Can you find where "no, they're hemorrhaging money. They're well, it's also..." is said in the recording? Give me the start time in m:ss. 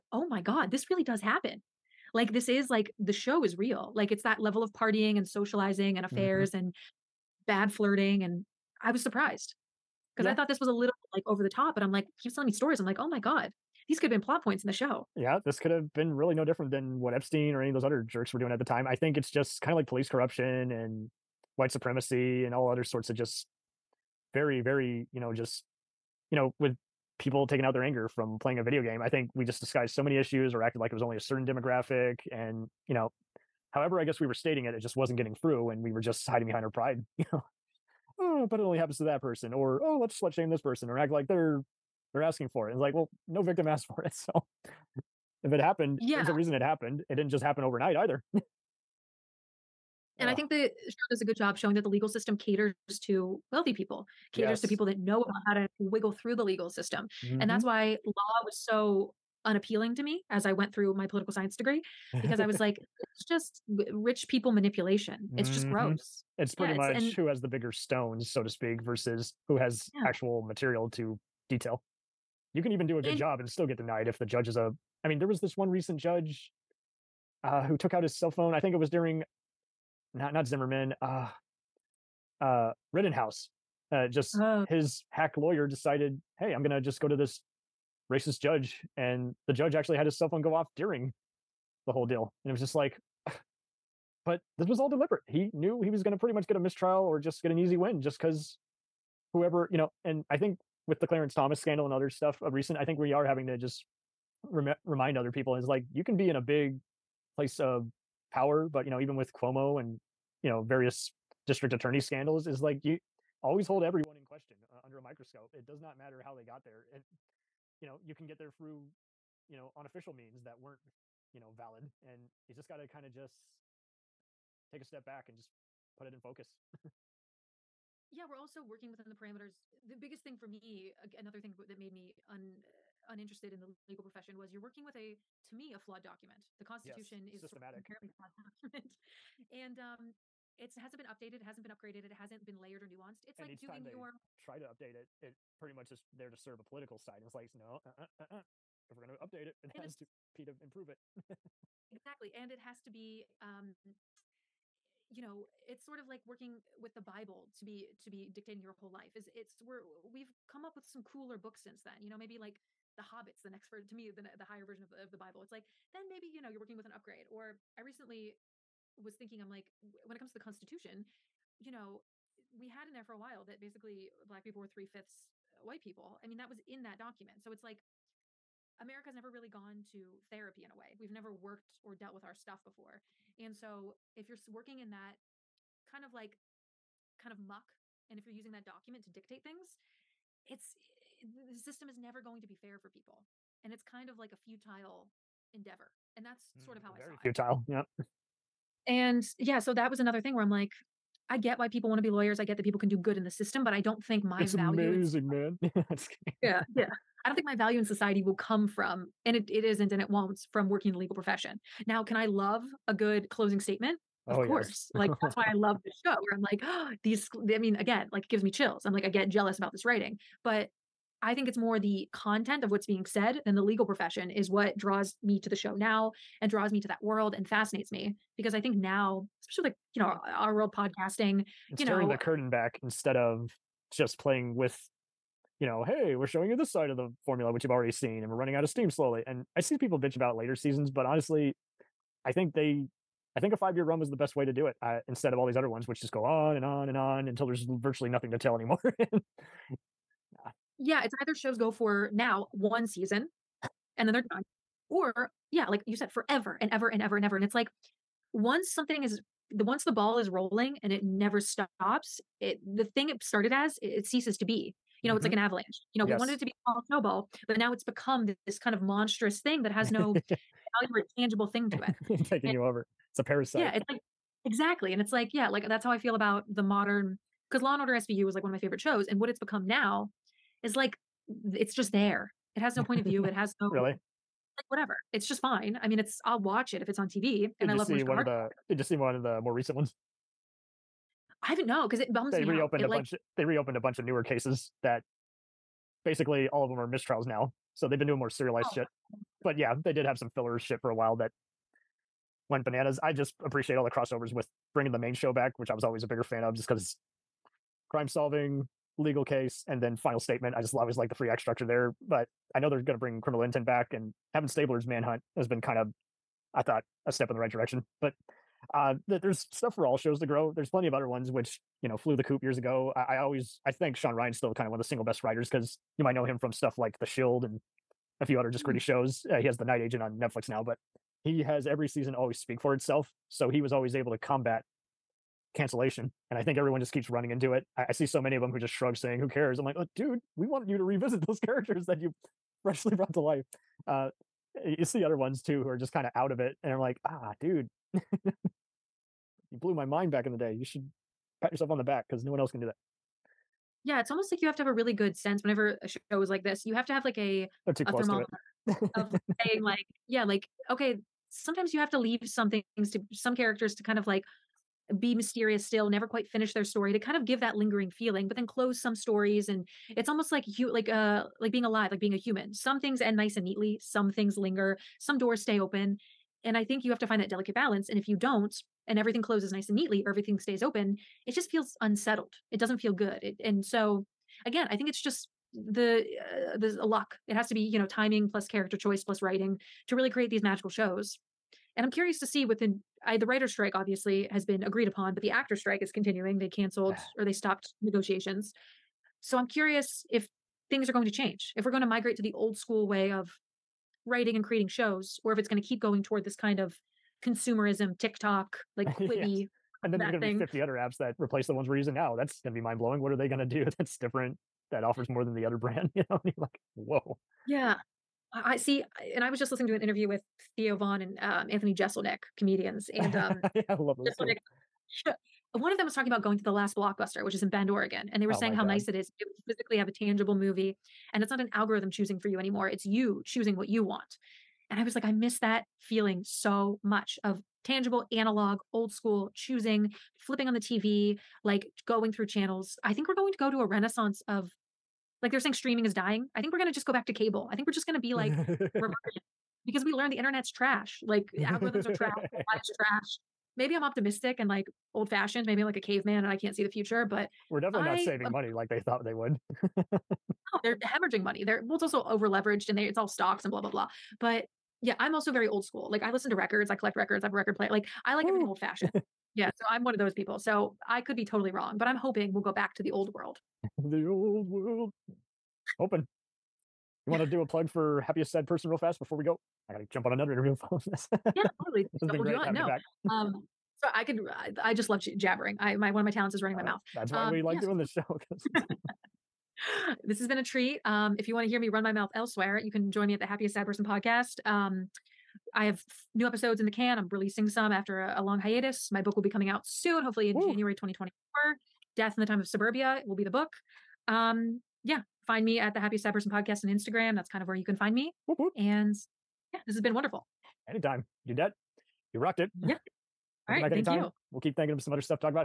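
7:39.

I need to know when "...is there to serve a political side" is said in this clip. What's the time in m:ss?
2:25.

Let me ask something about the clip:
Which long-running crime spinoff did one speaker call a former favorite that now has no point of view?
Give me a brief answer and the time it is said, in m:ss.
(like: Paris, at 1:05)
Law and Order SVU, at 4:37.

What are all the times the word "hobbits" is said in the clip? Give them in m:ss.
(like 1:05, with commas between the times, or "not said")
2:43.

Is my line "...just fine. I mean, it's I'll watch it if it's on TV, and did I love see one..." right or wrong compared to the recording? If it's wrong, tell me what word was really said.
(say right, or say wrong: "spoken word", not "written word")
right.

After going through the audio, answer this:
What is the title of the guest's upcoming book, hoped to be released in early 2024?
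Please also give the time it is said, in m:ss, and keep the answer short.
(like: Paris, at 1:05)
Death in the Time of Suburbia, at 8:21.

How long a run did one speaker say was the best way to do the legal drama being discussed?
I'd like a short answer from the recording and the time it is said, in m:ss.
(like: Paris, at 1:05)
five year, at 4:03.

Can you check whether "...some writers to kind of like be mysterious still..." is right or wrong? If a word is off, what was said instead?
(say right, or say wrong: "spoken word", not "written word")
wrong: "characters", not "writers".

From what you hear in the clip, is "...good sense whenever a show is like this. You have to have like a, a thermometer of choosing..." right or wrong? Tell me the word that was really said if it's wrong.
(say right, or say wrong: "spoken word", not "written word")
wrong: "saying", not "choosing".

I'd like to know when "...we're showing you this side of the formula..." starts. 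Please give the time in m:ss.
3:56.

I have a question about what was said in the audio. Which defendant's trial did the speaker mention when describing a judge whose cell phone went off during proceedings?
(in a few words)
Rittenhouse.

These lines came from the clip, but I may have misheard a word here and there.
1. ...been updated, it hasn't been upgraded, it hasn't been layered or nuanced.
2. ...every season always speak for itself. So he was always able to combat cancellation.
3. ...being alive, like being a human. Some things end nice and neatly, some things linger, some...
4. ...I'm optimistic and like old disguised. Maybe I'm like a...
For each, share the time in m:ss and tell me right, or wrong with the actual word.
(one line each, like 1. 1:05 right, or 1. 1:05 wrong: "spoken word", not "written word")
1. 2:20 right
2. 5:31 right
3. 6:11 right
4. 7:33 wrong: "fashioned", not "disguised".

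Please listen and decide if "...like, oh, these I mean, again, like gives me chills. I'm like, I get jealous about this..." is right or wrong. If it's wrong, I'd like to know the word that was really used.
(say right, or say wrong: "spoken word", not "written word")
right.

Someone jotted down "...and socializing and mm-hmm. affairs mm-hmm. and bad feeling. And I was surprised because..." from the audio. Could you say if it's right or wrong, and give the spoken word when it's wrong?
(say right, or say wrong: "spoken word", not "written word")
wrong: "flirting", not "feeling".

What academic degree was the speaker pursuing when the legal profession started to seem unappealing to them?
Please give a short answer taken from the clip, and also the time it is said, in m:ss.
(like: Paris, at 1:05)
political science, at 1:01.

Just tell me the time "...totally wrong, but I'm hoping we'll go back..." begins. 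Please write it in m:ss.
7:51.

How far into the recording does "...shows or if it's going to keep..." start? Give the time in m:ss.
6:44.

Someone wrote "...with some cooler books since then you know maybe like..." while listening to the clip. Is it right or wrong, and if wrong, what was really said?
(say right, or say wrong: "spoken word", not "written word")
right.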